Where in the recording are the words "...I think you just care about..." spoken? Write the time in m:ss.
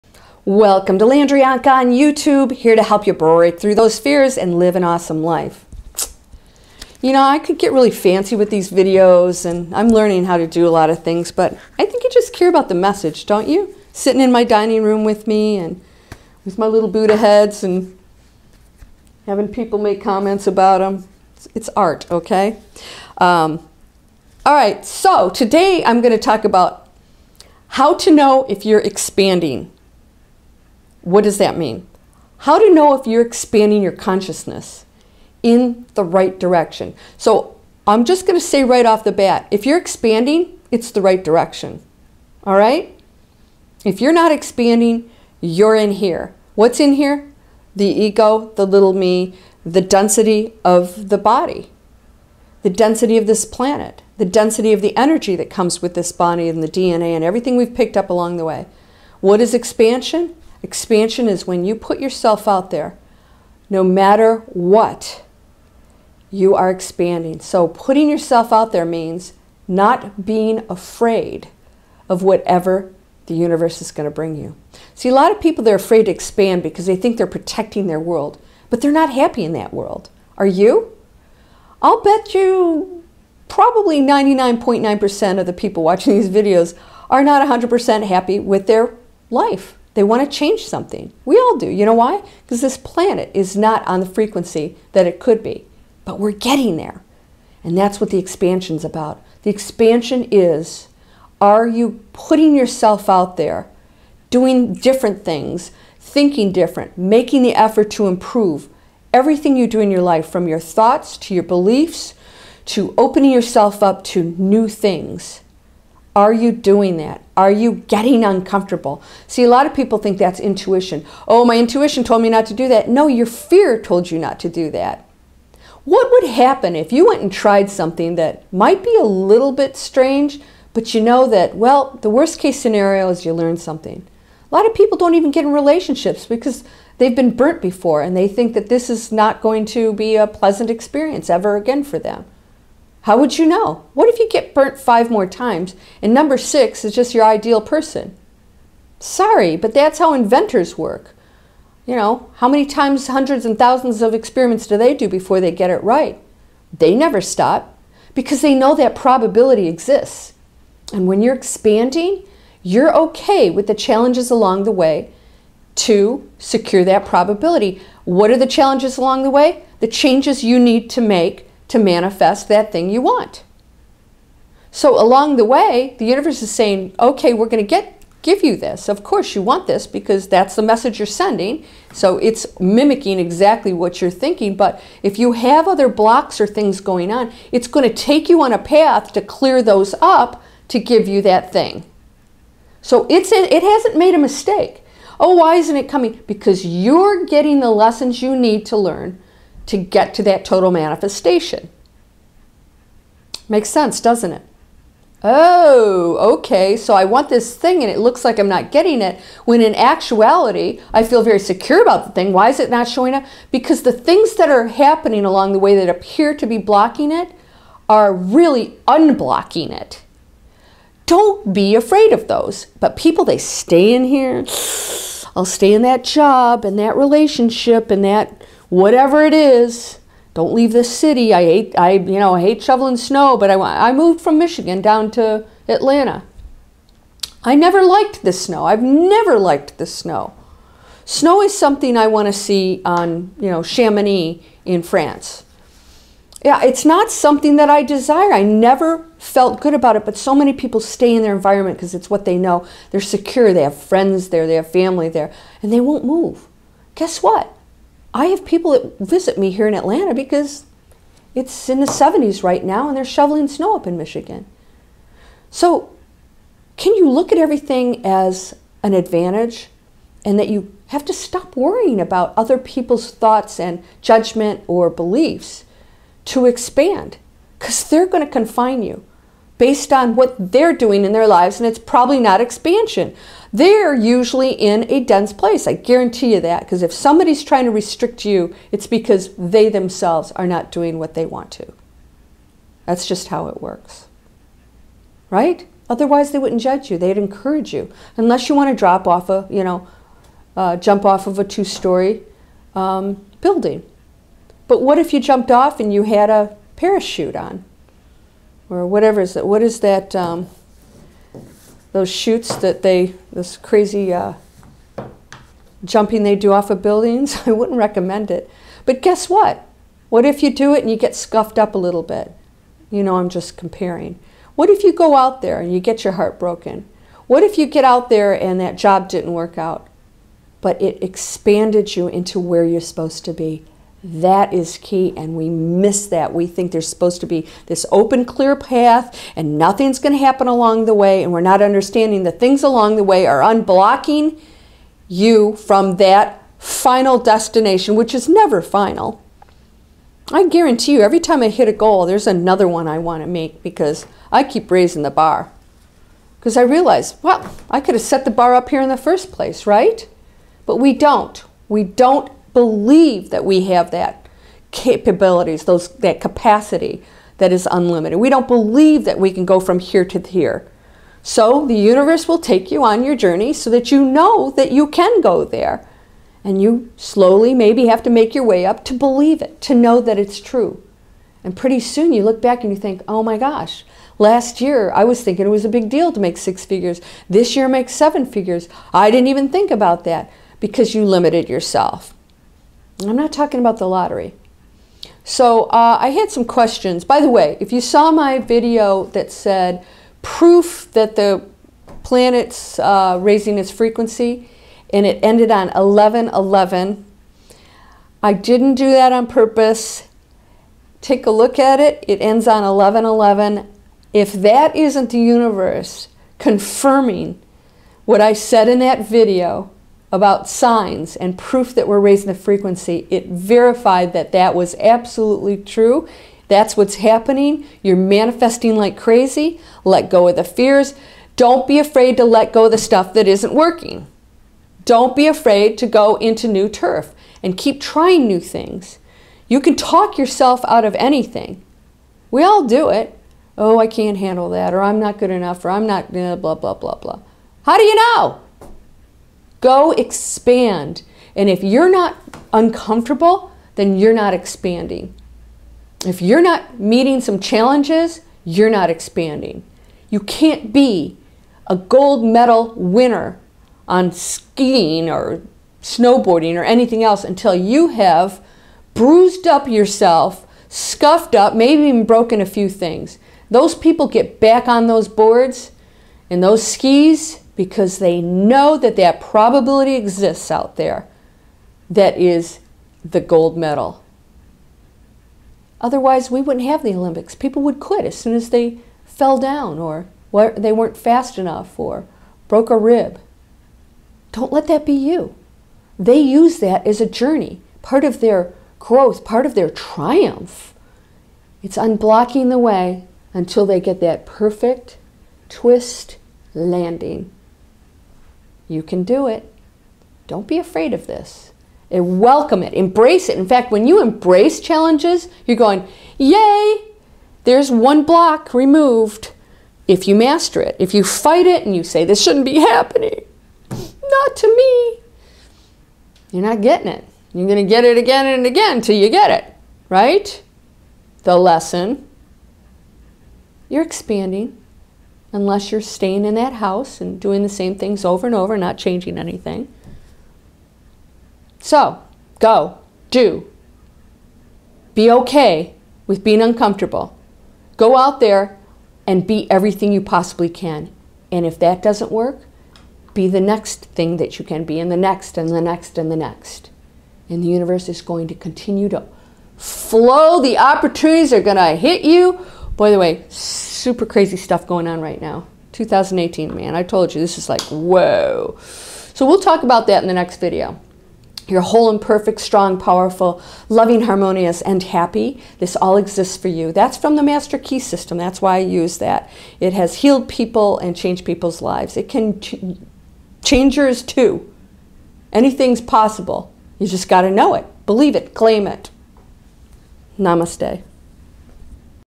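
0:11.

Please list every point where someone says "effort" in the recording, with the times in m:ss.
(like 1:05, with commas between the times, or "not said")
1:47.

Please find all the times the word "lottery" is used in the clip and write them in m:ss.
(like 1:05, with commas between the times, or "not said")
6:33.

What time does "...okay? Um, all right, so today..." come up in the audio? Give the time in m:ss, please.
0:22.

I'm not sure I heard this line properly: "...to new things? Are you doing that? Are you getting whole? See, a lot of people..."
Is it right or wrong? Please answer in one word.
wrong.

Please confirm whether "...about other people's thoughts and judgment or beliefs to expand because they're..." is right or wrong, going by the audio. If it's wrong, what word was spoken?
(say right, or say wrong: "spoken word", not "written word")
right.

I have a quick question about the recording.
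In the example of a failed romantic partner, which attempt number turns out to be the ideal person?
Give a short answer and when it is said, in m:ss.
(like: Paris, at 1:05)
6, at 2:26.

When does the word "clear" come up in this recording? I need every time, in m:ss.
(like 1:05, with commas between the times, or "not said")
3:09, 5:38.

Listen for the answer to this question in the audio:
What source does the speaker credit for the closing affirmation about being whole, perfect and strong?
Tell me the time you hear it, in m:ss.
9:37.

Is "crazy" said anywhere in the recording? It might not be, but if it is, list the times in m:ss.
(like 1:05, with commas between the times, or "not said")
5:13, 7:08, 9:24.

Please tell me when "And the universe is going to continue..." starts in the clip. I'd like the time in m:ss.
9:17.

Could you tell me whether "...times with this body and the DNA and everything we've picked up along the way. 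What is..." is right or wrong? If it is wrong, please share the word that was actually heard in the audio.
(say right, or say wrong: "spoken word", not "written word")
wrong: "comes", not "times".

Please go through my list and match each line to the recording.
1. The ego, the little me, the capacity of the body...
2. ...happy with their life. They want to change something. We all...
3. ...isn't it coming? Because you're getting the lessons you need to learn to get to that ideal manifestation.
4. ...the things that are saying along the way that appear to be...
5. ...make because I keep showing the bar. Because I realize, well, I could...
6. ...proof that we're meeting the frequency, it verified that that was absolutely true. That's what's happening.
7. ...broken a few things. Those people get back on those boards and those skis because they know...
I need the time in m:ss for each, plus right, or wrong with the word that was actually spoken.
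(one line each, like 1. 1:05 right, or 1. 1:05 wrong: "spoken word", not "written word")
1. 0:47 wrong: "density", not "capacity"
2. 1:28 right
3. 3:15 wrong: "total", not "ideal"
4. 3:33 wrong: "happening", not "saying"
5. 5:53 wrong: "raising", not "showing"
6. 7:01 wrong: "raising", not "meeting"
7. 7:52 right.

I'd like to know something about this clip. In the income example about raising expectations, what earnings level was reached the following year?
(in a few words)
seven figures.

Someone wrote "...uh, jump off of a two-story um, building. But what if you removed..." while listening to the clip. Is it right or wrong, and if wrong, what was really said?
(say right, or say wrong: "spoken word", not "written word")
wrong: "jumped", not "removed".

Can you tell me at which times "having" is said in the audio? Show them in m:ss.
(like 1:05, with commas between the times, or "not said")
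0:19.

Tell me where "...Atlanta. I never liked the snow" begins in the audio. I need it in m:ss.
3:55.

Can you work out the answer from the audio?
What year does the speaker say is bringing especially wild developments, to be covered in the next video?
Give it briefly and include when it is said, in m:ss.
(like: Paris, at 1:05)
2018, at 9:25.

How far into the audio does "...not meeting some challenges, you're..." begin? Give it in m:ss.
7:36.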